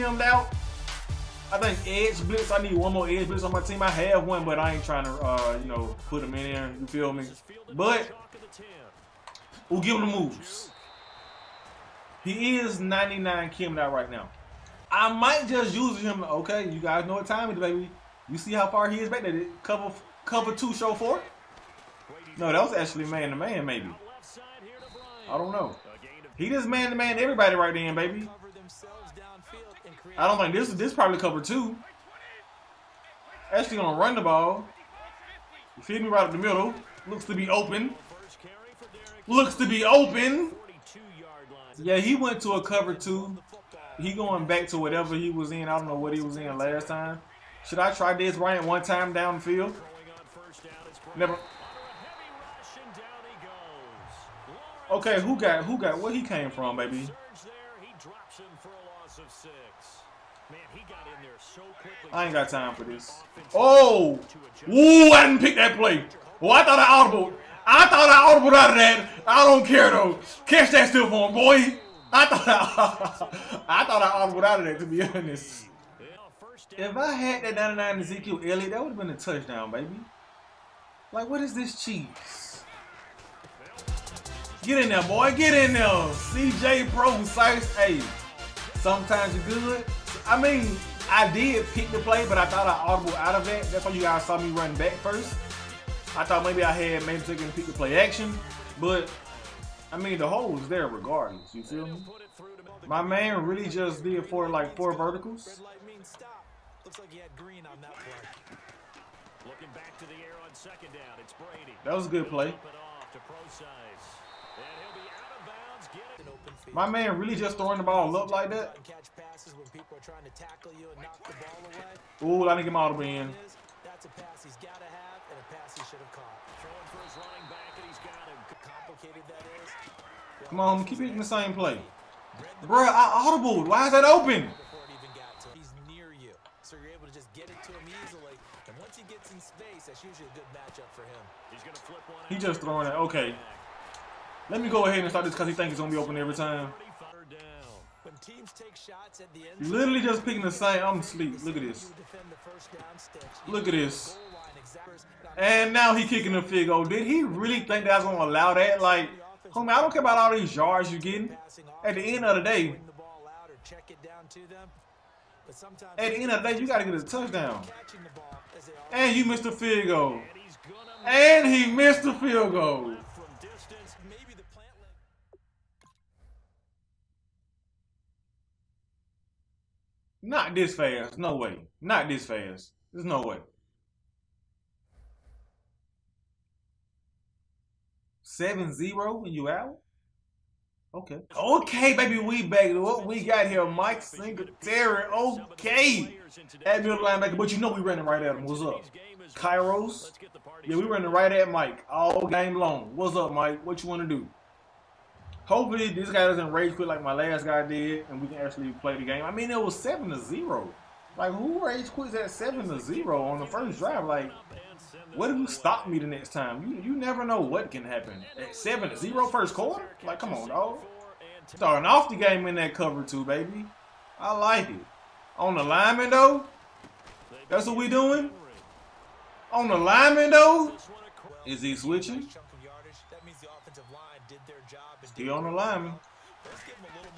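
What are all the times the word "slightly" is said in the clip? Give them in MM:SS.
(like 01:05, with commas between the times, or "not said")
not said.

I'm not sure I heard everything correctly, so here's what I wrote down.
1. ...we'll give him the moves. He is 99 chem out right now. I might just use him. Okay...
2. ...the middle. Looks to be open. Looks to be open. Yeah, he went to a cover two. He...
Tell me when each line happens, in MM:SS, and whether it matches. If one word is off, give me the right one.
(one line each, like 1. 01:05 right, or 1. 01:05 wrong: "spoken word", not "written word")
1. 00:09 right
2. 00:36 right.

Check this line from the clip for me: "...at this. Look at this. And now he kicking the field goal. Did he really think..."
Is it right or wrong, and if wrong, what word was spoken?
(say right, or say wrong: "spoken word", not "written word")
right.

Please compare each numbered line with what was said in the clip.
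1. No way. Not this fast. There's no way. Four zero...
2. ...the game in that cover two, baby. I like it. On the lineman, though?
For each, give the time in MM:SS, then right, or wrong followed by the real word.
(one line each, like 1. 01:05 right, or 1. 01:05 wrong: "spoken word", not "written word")
1. 03:01 wrong: "Seven", not "Four"
2. 03:42 right.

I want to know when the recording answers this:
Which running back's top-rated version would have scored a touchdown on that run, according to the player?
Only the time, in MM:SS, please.
01:17.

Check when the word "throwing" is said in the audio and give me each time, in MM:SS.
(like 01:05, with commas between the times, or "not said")
01:57, 02:06, 02:22.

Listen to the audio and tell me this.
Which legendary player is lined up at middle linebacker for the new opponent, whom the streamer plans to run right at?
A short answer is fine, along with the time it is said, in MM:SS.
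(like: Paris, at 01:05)
Mike Singletary, at 03:13.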